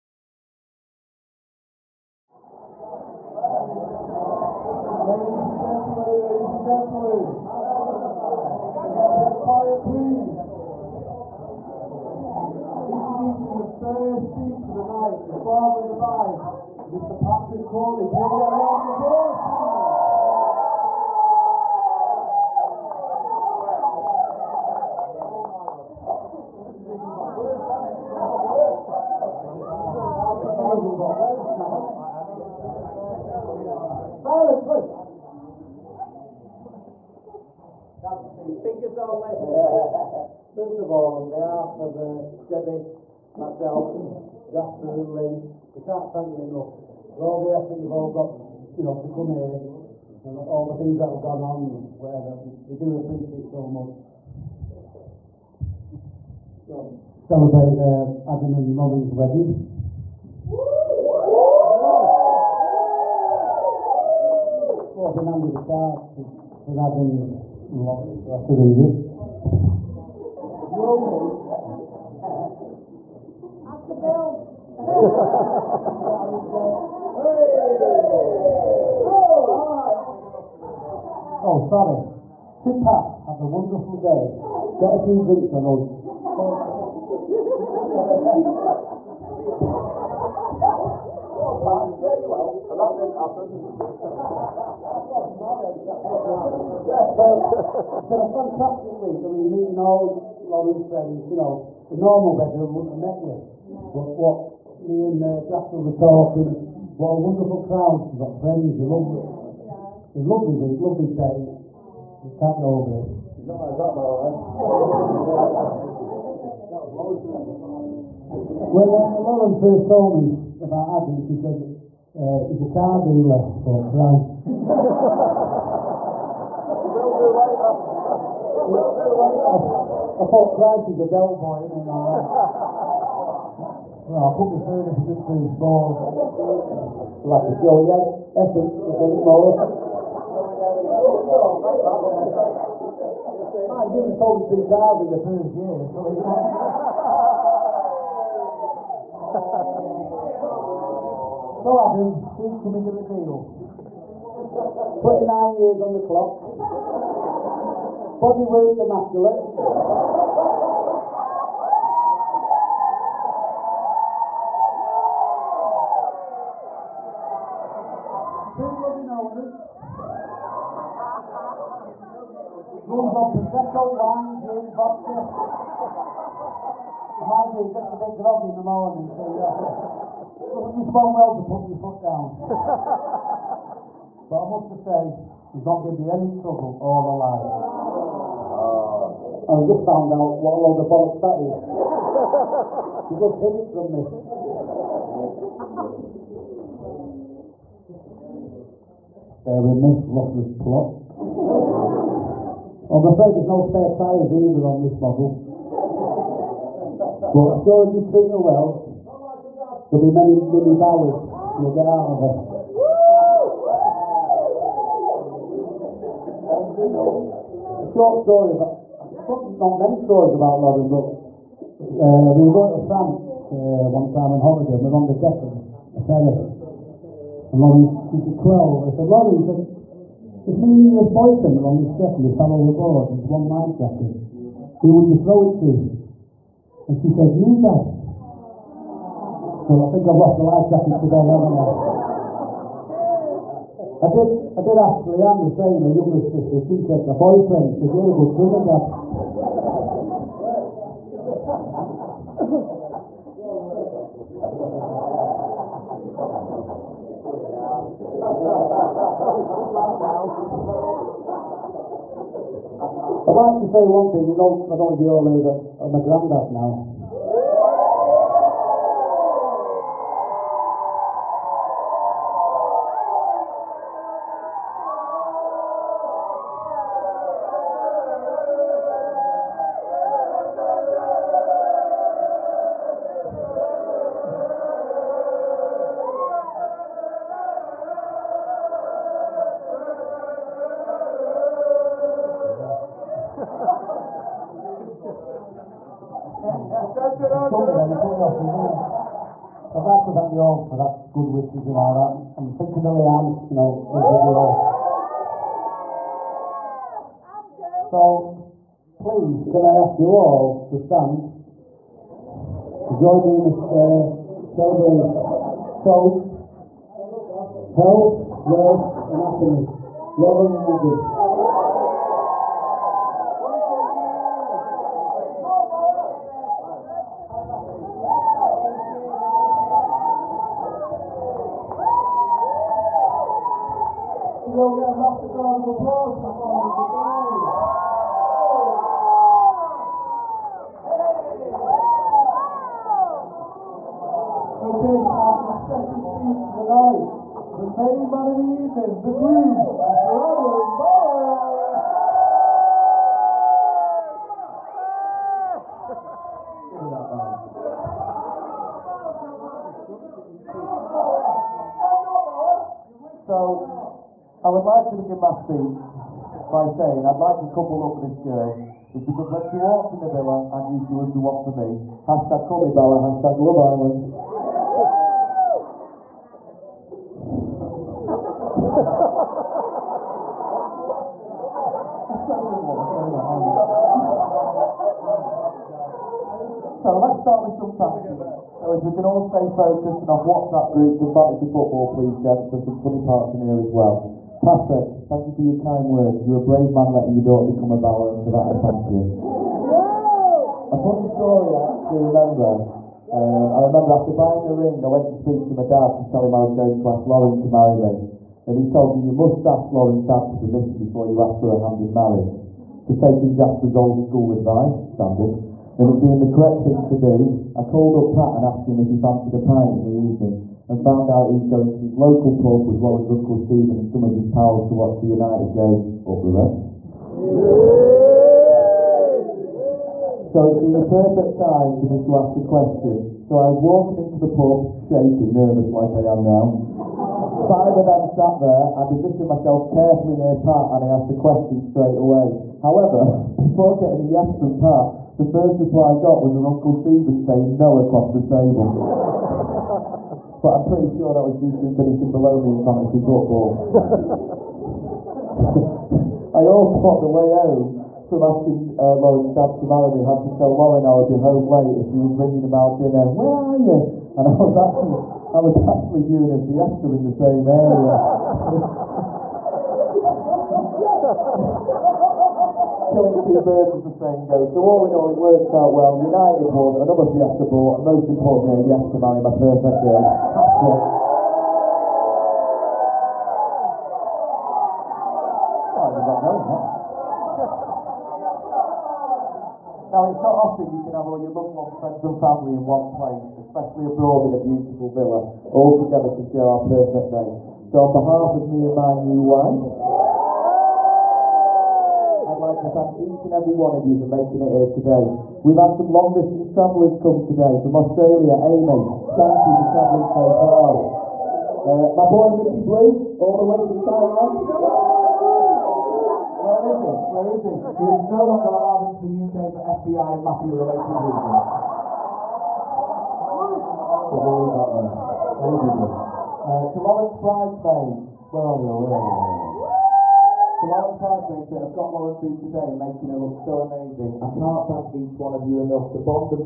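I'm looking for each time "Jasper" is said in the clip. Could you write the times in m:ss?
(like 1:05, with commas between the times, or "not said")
0:44, 1:45, 6:53.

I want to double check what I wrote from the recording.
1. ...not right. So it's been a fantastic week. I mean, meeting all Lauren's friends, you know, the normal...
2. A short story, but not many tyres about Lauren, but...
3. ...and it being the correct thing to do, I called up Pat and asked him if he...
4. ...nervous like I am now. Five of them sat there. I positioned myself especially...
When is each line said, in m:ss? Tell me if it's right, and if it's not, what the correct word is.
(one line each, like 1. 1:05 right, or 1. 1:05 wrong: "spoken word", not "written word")
1. 1:36 right
2. 3:37 wrong: "stories", not "tyres"
3. 6:55 right
4. 7:15 wrong: "carefully", not "especially".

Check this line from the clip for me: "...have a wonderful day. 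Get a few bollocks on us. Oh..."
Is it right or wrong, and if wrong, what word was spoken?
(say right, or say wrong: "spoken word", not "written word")
wrong: "drinks", not "bollocks".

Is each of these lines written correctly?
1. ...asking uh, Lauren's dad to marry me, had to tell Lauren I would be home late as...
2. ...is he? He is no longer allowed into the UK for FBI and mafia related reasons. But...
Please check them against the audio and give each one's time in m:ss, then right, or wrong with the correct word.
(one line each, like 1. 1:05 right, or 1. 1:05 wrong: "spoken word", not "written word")
1. 7:38 right
2. 8:37 right.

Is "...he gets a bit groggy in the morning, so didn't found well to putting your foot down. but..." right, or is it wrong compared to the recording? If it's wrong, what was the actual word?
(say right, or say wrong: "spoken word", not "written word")
wrong: "respond", not "found".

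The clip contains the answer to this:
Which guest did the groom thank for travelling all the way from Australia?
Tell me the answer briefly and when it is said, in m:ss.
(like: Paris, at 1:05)
Amy, at 8:28.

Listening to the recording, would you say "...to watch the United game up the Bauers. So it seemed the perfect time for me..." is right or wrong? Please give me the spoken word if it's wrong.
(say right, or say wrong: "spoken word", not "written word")
wrong: "Reds", not "Bauers".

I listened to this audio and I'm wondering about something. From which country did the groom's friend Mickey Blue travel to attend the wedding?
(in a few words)
Thailand.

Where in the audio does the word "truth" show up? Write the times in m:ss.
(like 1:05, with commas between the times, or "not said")
2:15.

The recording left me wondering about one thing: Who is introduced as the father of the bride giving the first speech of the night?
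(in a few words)
Patrick Corley.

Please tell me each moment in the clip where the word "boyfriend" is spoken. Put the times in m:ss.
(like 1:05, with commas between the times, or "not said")
3:51, 4:07.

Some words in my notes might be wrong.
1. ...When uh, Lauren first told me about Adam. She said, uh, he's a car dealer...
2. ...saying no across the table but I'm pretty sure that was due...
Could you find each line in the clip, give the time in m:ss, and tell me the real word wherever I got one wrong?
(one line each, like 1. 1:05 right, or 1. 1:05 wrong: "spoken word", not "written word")
1. 1:58 right
2. 7:27 right.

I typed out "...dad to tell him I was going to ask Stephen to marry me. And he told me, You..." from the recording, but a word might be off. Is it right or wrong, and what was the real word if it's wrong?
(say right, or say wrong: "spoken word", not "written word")
wrong: "Lauren", not "Stephen".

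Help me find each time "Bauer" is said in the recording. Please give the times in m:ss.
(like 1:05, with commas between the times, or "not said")
3:30, 5:50, 6:12, 6:37.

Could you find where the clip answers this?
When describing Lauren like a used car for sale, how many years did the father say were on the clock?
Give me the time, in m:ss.
2:34.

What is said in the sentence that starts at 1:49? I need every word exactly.
It's a lovely week, lovely day.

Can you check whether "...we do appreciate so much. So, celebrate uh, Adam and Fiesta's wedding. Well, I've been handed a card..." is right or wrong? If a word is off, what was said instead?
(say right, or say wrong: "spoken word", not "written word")
wrong: "Lauren", not "Fiesta".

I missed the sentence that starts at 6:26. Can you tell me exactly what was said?
so let's start with some clapping.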